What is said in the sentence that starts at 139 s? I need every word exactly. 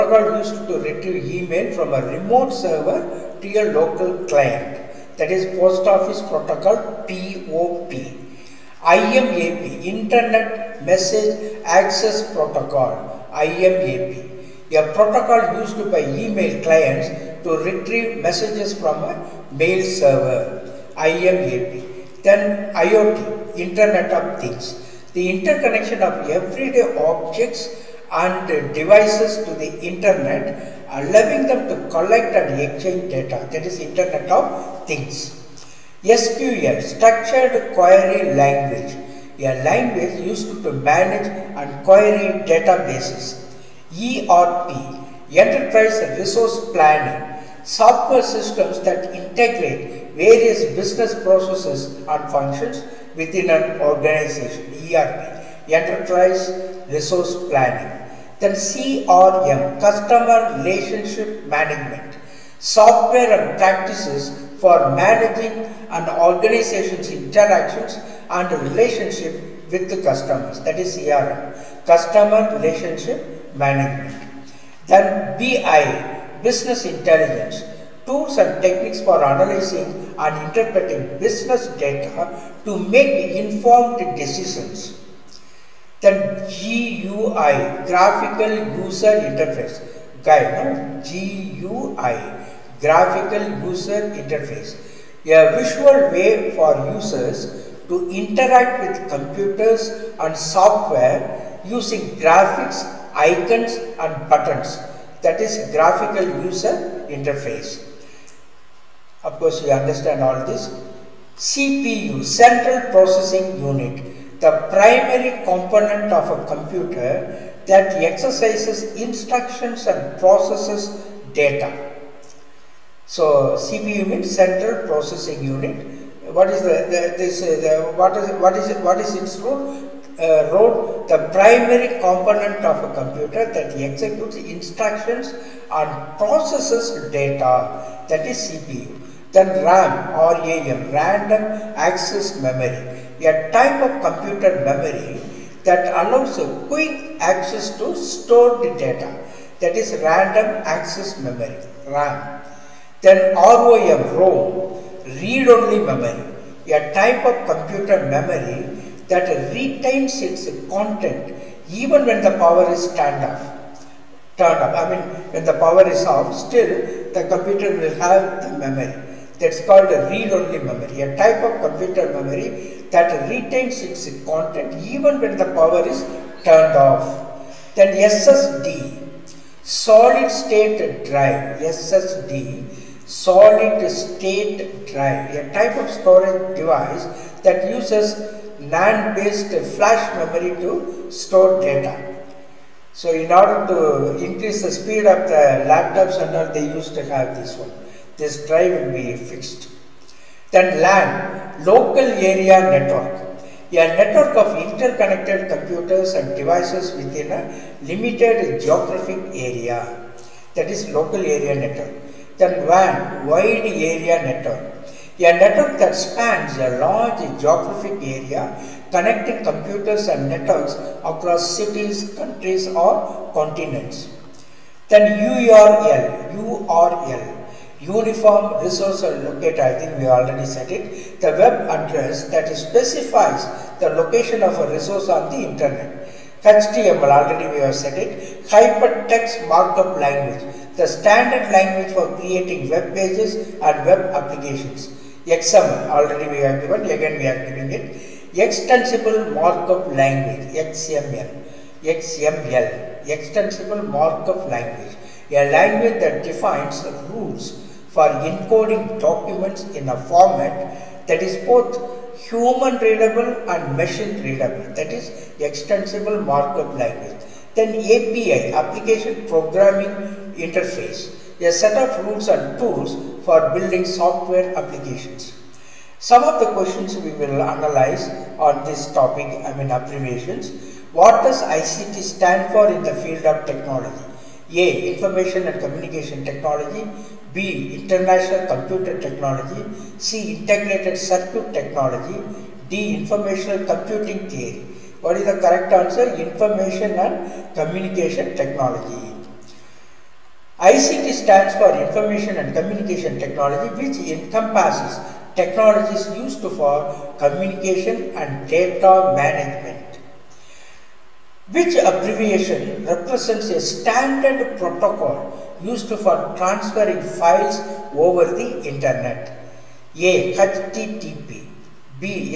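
Then RAM or AM, random access memory, a type of computer memory that allows a quick access to stored data.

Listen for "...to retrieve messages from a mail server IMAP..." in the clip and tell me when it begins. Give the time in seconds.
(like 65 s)
17 s.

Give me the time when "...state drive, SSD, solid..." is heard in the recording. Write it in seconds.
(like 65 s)
180 s.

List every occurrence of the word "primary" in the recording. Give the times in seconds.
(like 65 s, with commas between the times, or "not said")
114 s, 131 s.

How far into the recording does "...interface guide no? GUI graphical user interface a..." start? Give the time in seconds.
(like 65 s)
89 s.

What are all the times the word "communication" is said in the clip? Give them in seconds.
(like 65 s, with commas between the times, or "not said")
285 s, 297 s, 302 s, 307 s.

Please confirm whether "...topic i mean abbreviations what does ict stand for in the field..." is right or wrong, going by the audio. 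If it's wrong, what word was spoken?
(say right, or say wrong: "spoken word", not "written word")
right.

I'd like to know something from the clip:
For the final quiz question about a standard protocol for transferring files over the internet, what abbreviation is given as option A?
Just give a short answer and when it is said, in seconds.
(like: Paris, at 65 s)
HTTP, at 320 s.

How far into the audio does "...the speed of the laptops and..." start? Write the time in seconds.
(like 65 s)
194 s.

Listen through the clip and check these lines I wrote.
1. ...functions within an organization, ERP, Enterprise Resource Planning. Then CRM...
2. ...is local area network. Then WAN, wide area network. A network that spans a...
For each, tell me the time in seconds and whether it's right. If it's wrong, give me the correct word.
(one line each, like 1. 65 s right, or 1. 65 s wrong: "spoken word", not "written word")
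1. 52 s right
2. 210 s right.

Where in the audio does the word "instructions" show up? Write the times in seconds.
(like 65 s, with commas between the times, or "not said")
119 s, 134 s.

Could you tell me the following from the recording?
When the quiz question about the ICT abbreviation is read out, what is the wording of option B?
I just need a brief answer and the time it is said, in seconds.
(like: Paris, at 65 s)
International Computer Technology, at 287 s.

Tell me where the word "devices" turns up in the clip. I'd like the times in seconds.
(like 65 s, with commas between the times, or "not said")
28 s, 186 s, 206 s.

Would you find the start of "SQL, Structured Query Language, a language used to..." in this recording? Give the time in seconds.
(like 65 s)
36 s.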